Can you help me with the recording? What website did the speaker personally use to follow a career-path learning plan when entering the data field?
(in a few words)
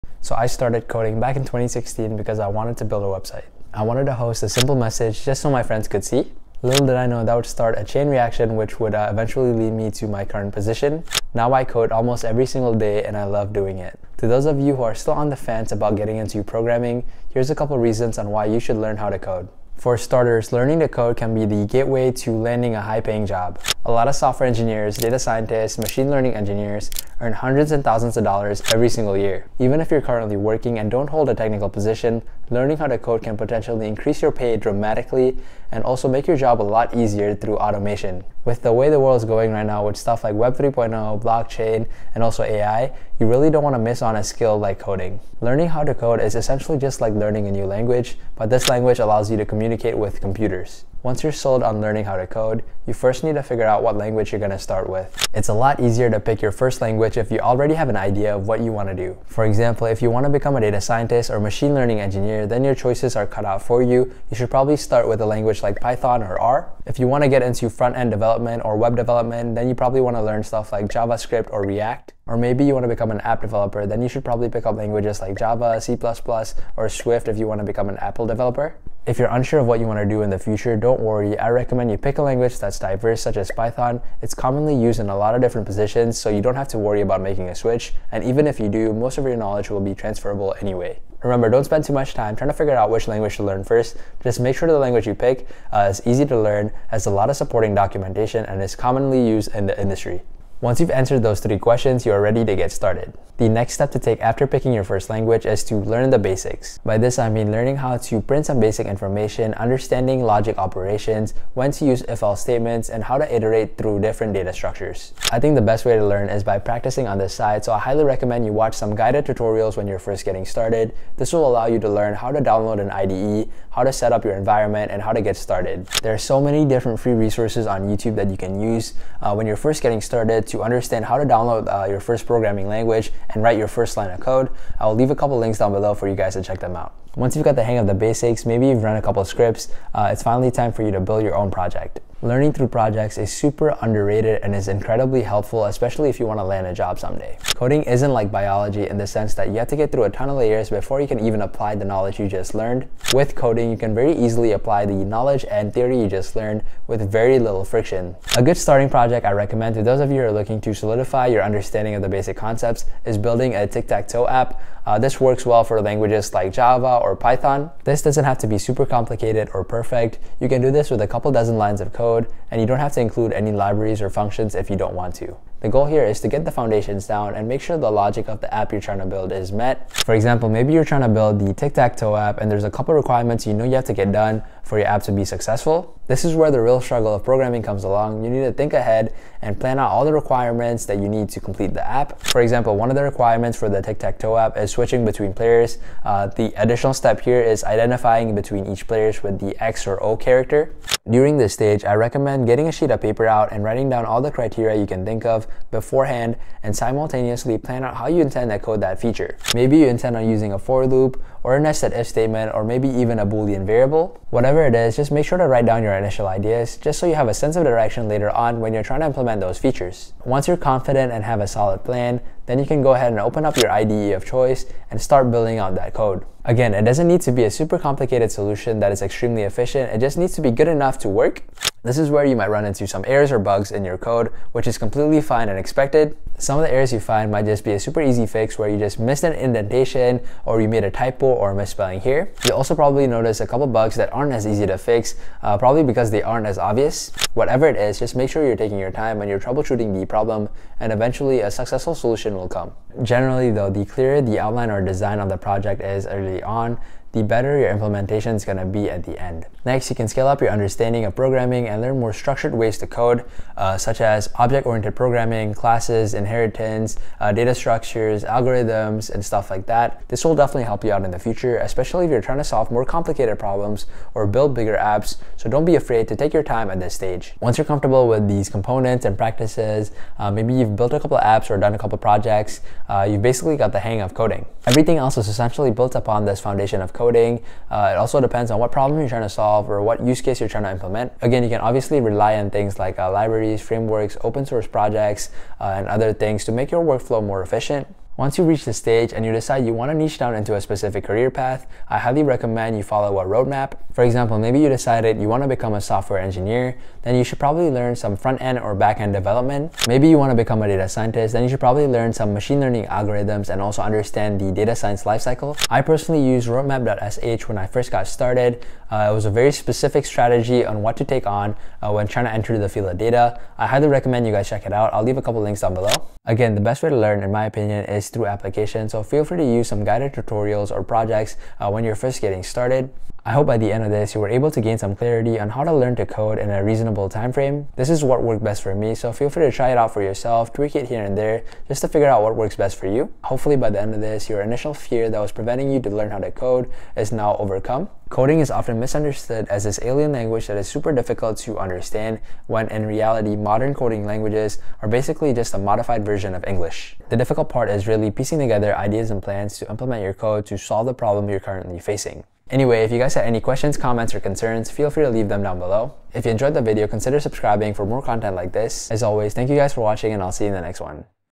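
roadmap.sh.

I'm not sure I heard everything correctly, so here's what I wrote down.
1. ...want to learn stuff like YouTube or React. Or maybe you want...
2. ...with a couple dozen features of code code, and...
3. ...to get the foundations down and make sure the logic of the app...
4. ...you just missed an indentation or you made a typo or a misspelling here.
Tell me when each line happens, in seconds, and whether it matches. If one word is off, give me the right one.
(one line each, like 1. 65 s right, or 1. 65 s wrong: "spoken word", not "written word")
1. 70 s wrong: "JavaScript", not "YouTube"
2. 170 s wrong: "lines", not "features"
3. 176 s right
4. 238 s right.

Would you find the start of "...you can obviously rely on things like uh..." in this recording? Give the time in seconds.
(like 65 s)
291 s.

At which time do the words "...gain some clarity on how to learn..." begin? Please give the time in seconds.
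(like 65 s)
334 s.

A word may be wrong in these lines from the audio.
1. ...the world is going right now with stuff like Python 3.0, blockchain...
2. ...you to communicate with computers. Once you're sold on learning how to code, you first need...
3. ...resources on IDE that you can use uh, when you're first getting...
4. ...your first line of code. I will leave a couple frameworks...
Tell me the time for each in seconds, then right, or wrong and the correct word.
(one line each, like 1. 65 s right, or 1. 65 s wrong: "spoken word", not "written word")
1. 38 s wrong: "Web", not "Python"
2. 49 s right
3. 127 s wrong: "YouTube", not "IDE"
4. 133 s wrong: "links", not "frameworks".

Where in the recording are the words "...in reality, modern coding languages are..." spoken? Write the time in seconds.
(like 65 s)
352 s.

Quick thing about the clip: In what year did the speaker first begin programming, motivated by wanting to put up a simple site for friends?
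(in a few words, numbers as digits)
2016.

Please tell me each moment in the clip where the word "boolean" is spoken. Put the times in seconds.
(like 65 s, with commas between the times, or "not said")
213 s.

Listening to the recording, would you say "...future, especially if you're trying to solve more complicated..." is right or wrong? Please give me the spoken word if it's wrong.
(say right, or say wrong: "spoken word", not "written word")
right.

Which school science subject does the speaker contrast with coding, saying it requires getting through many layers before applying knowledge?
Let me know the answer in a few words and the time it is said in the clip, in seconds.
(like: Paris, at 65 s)
Biology, at 148 s.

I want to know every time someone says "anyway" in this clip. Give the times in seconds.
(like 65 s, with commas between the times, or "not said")
90 s, 362 s.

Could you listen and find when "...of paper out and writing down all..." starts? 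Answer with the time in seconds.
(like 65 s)
202 s.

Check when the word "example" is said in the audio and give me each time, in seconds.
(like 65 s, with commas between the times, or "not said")
59 s, 180 s, 192 s, 304 s.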